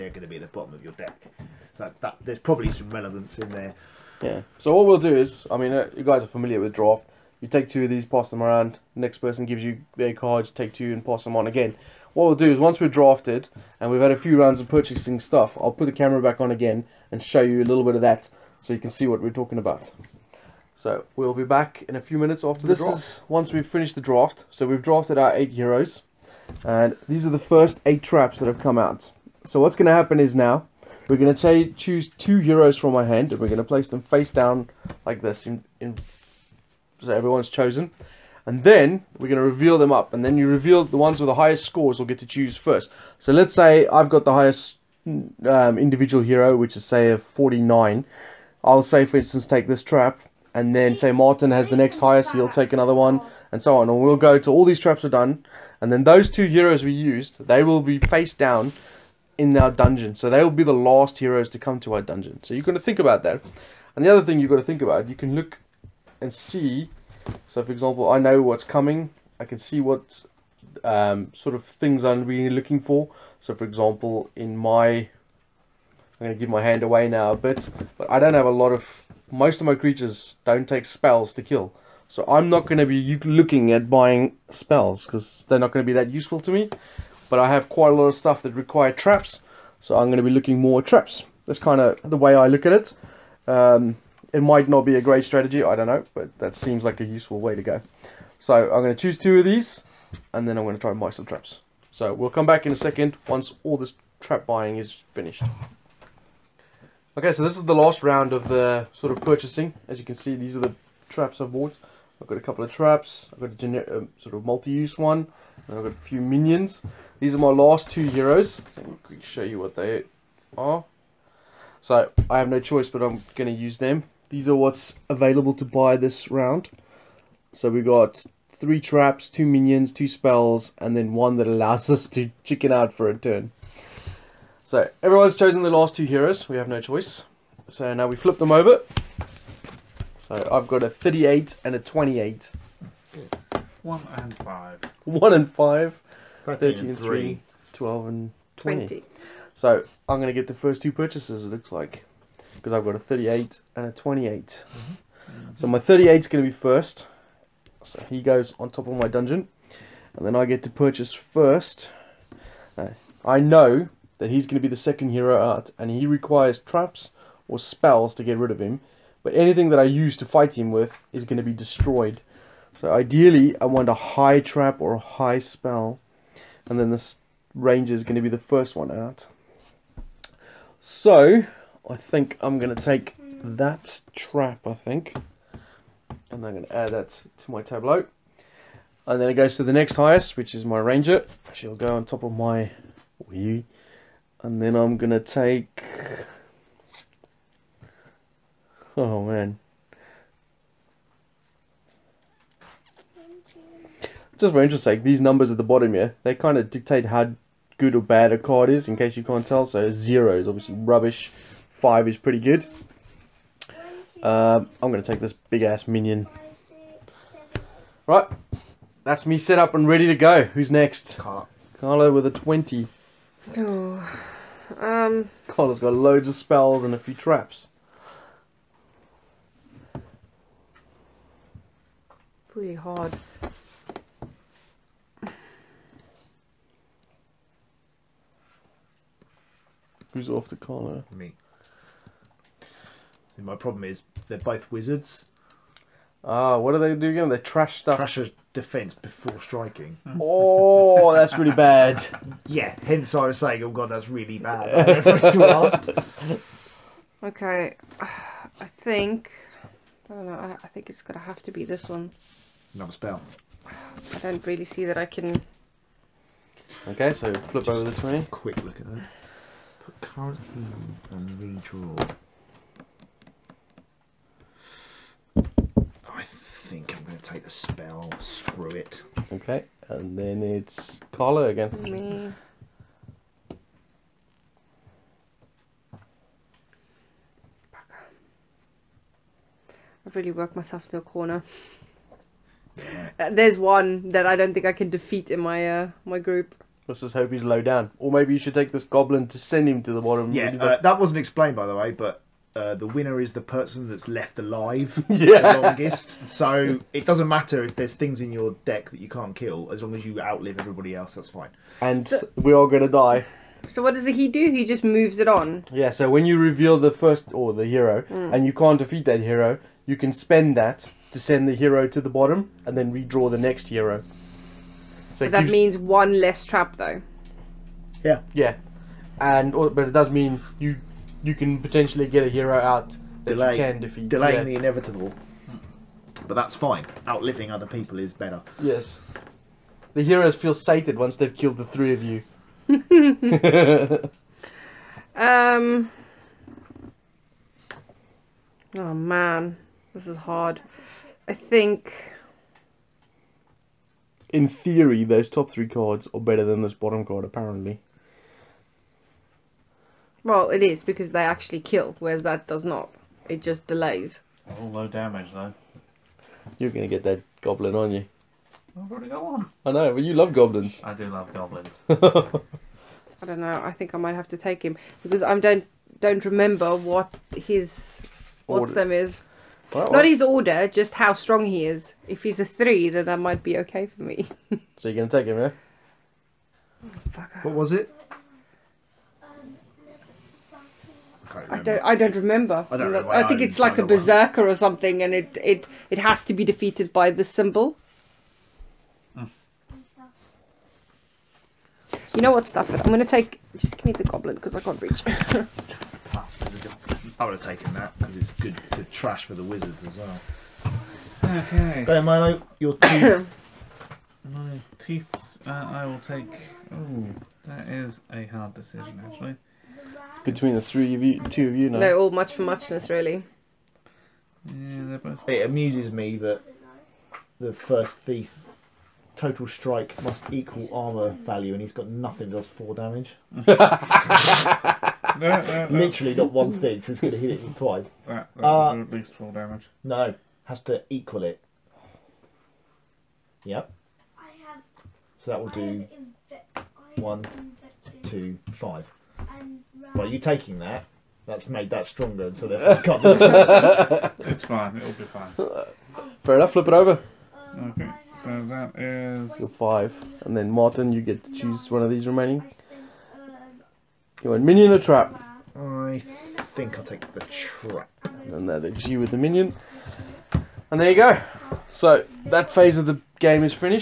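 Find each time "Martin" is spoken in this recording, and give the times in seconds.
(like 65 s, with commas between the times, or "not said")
51 s, 460 s.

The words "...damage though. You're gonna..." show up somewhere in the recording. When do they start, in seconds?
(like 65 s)
364 s.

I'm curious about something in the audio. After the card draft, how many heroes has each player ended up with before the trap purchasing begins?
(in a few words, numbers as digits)
8.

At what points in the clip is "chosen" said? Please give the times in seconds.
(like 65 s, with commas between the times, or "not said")
37 s, 135 s.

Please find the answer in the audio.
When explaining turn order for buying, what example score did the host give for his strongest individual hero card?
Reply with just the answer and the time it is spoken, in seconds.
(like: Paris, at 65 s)
49, at 47 s.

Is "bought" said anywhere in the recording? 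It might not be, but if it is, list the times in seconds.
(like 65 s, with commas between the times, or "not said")
111 s.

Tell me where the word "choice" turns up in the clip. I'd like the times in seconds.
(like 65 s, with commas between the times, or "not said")
122 s, 136 s.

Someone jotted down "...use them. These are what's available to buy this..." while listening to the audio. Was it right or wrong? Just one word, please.
right.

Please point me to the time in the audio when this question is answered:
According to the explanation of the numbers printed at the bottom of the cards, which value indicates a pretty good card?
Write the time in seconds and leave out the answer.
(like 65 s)
211 s.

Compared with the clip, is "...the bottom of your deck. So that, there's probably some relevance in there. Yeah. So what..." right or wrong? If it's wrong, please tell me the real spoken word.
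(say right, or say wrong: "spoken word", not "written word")
right.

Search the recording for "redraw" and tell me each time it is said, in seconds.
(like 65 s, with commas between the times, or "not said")
271 s, 322 s.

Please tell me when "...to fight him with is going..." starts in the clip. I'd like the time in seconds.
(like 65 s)
170 s.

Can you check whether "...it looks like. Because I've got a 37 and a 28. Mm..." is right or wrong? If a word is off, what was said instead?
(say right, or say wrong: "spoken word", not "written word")
wrong: "38", not "37".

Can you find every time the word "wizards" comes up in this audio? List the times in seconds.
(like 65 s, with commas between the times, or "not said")
244 s, 409 s.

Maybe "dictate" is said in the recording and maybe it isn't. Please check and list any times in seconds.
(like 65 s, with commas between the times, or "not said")
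206 s.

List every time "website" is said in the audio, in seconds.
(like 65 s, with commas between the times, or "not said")
not said.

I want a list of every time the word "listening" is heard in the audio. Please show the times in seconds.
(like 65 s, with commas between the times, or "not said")
not said.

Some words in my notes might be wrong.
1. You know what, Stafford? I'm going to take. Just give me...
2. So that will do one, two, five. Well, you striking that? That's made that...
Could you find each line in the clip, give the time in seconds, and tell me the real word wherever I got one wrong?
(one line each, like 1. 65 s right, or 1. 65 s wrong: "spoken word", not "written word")
1. 402 s right
2. 445 s wrong: "taking", not "striking".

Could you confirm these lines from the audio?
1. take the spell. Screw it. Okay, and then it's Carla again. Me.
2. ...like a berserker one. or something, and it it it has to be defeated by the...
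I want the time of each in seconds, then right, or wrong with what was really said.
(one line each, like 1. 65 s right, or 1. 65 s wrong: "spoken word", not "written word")
1. 277 s right
2. 393 s right.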